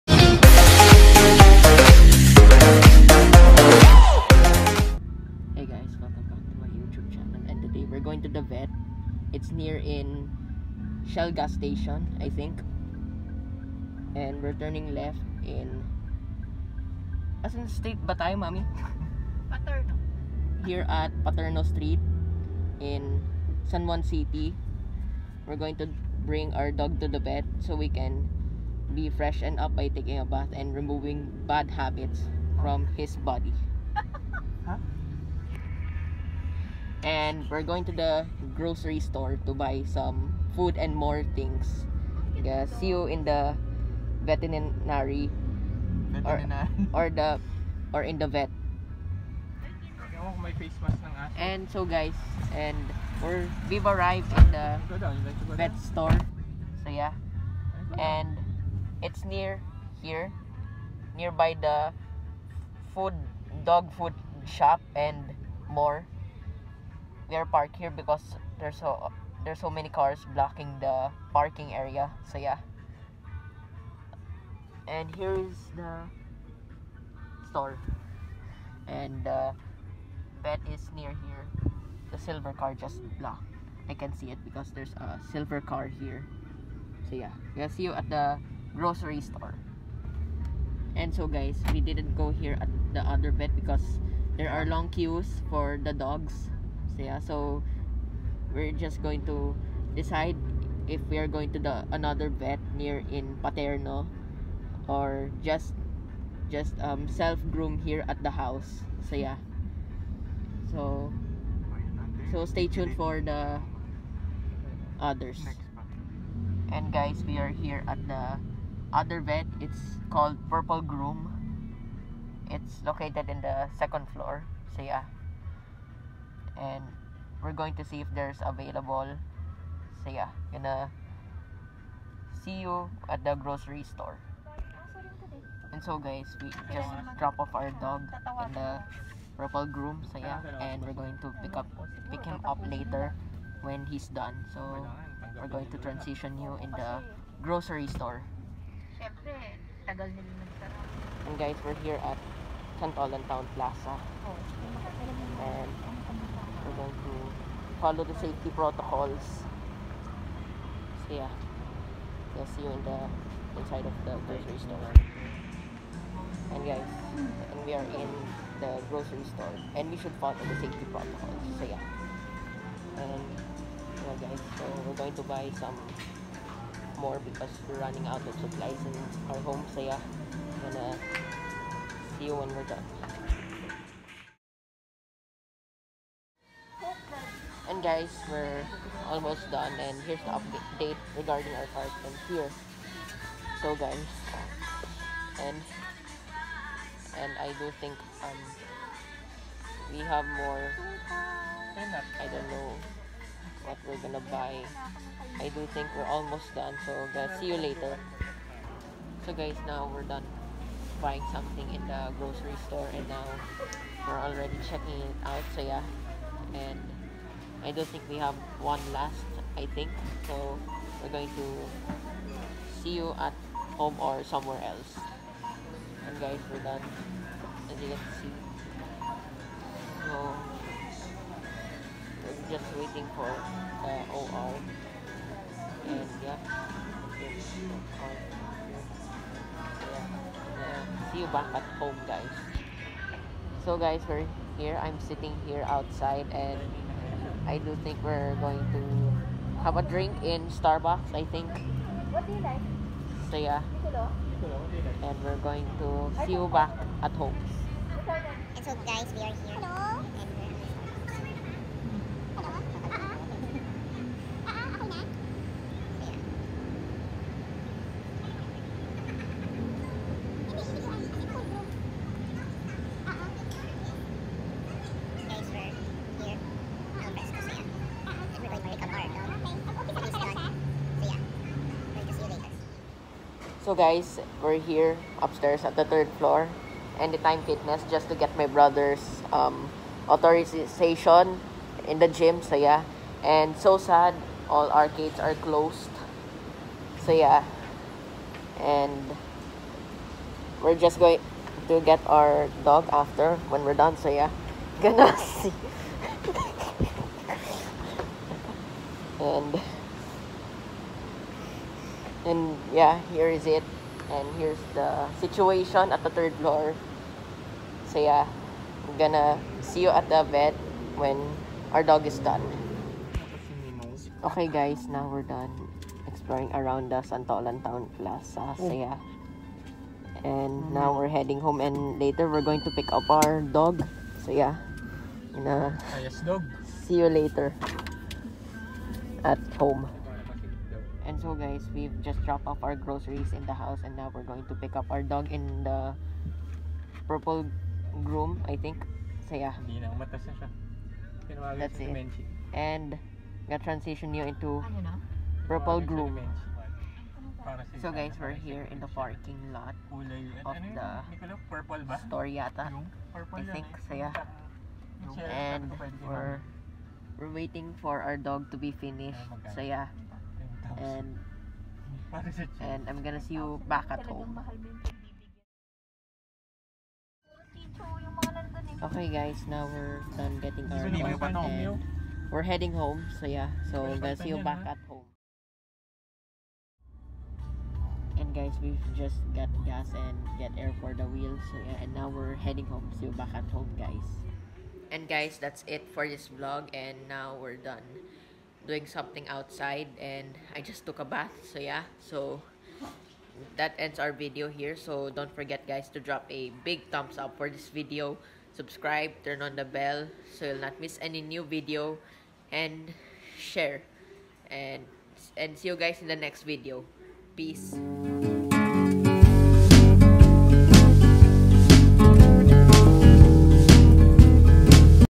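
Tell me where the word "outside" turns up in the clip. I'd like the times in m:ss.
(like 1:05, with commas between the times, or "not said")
4:05, 6:39.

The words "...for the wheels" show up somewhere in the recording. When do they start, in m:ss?
6:30.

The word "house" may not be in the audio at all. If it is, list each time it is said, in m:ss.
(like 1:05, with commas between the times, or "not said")
1:48, 5:43.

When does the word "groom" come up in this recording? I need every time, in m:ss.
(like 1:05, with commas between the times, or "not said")
1:47, 2:00, 2:19, 5:48, 5:55.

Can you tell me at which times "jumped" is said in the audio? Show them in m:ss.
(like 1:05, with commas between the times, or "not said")
not said.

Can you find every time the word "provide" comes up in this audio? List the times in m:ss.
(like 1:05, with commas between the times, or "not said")
not said.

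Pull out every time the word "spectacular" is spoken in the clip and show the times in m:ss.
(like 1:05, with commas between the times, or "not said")
not said.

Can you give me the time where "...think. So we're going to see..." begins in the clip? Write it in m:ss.
3:39.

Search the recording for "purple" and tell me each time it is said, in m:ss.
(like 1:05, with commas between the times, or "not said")
2:00, 2:19, 5:47, 5:55.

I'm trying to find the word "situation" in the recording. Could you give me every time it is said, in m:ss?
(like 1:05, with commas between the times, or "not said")
5:15.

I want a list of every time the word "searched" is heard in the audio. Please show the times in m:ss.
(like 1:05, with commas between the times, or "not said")
not said.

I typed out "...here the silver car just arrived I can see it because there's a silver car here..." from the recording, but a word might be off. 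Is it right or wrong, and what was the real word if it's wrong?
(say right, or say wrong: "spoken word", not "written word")
wrong: "blocked", not "arrived".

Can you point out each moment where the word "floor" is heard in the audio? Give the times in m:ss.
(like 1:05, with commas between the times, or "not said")
2:04, 4:46, 5:16.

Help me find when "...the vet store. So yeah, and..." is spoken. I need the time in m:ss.
0:54.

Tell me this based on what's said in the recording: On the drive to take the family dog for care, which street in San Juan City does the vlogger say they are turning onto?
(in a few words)
Paterno Street.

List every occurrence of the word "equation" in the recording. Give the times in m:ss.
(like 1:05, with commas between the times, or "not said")
not said.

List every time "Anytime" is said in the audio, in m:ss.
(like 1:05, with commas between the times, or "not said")
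4:46.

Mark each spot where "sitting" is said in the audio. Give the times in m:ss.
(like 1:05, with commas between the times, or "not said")
4:04.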